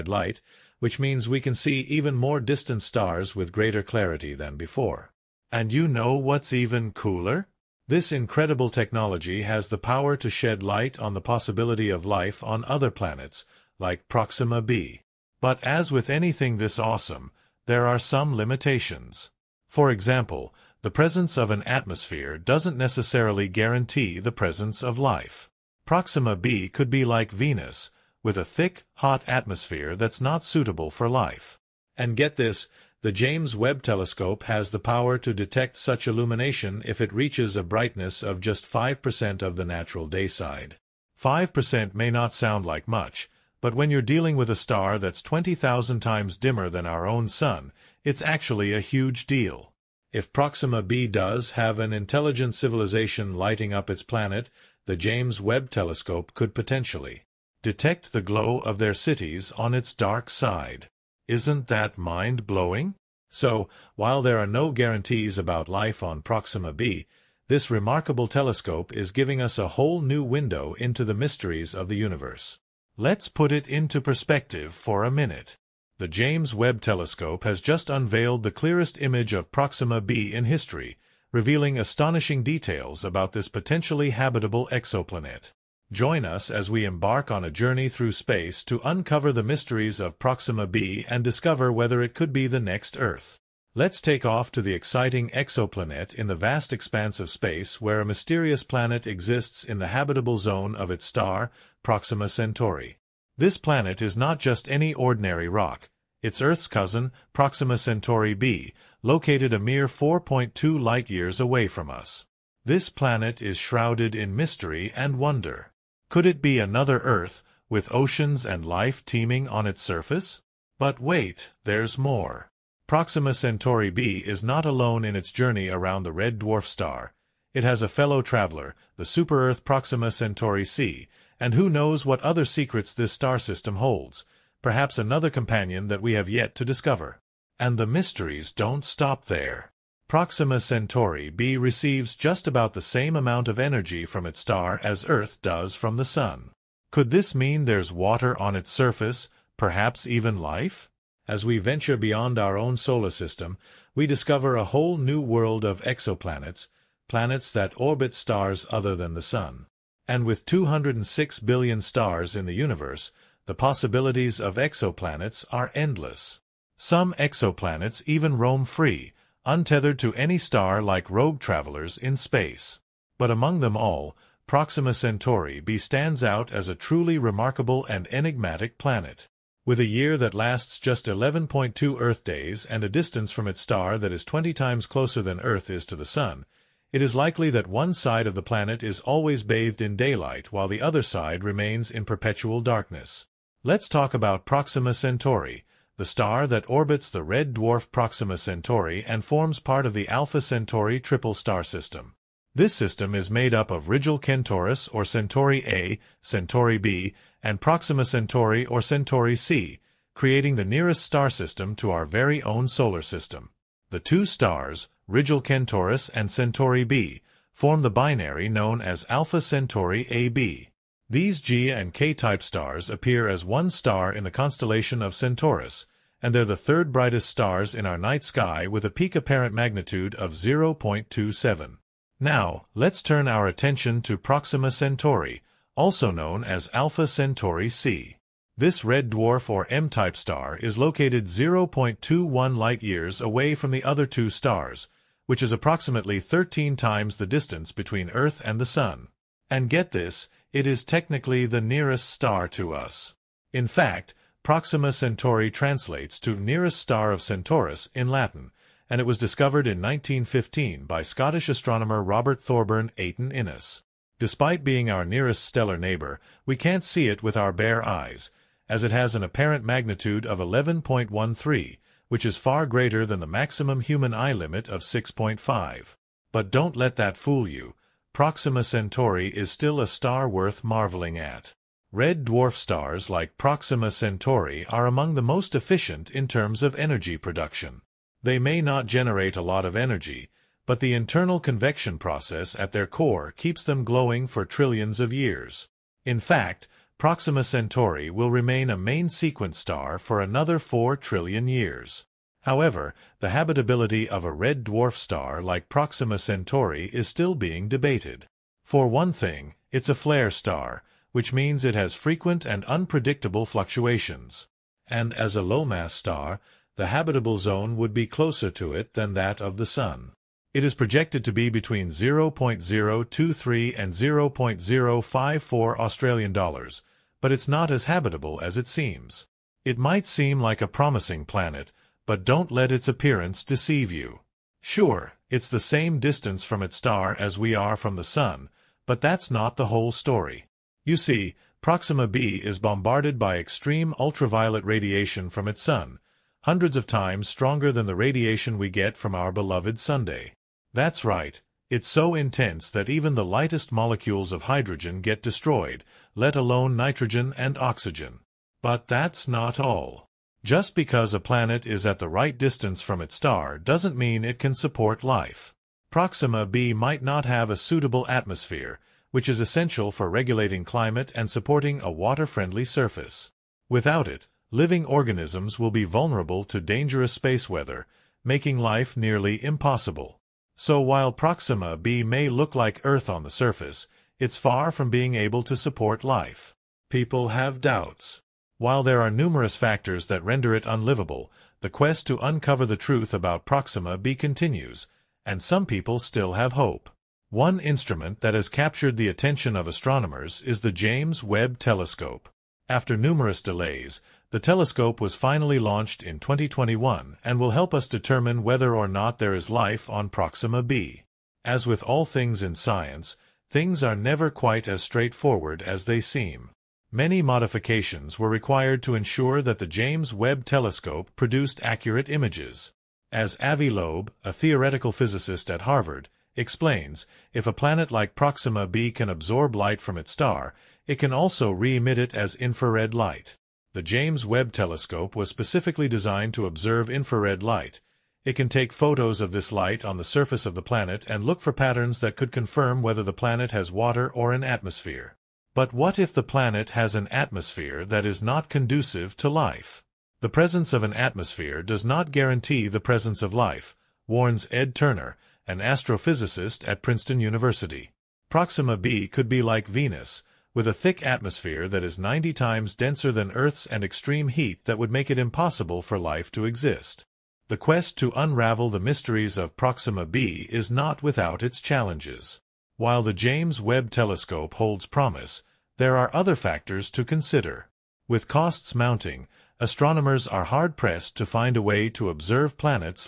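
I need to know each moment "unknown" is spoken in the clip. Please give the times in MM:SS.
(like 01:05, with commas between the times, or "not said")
not said.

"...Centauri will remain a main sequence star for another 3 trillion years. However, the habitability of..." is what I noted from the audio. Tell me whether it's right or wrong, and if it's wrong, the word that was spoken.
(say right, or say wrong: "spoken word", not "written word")
wrong: "4", not "3".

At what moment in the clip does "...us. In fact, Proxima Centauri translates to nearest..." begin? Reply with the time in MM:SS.
04:12.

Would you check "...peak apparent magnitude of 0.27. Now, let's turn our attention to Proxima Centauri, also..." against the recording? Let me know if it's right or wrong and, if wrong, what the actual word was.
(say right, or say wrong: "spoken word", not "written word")
right.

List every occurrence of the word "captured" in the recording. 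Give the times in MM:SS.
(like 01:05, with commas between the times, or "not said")
06:38.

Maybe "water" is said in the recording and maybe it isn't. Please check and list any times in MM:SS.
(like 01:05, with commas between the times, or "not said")
02:27, 06:11, 07:23.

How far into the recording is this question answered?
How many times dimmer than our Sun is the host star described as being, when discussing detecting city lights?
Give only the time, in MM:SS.
00:45.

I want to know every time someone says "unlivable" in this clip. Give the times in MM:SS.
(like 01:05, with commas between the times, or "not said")
06:30.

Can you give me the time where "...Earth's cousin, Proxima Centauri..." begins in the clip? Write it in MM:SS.
01:46.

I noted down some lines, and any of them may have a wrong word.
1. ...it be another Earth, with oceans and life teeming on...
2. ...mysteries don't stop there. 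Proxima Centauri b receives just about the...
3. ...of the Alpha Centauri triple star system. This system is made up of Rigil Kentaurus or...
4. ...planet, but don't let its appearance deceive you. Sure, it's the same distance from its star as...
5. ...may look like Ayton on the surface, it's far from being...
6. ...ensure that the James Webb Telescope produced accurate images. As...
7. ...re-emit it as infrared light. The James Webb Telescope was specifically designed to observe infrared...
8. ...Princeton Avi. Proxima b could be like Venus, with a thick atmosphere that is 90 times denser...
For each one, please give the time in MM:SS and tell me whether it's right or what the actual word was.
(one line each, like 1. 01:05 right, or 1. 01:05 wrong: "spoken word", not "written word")
1. 01:56 right
2. 02:17 right
3. 03:19 right
4. 05:31 right
5. 06:22 wrong: "Earth", not "Ayton"
6. 06:58 right
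7. 07:11 right
8. 07:36 wrong: "University", not "Avi".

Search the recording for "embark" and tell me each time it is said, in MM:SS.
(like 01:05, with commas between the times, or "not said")
01:26.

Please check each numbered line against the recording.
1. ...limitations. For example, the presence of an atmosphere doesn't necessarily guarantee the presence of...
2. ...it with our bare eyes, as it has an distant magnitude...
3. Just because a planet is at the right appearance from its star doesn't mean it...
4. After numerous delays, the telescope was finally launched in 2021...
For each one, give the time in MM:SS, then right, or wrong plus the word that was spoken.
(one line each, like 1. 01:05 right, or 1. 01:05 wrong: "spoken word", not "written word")
1. 00:18 right
2. 04:27 wrong: "apparent", not "distant"
3. 06:00 wrong: "distance", not "appearance"
4. 06:42 right.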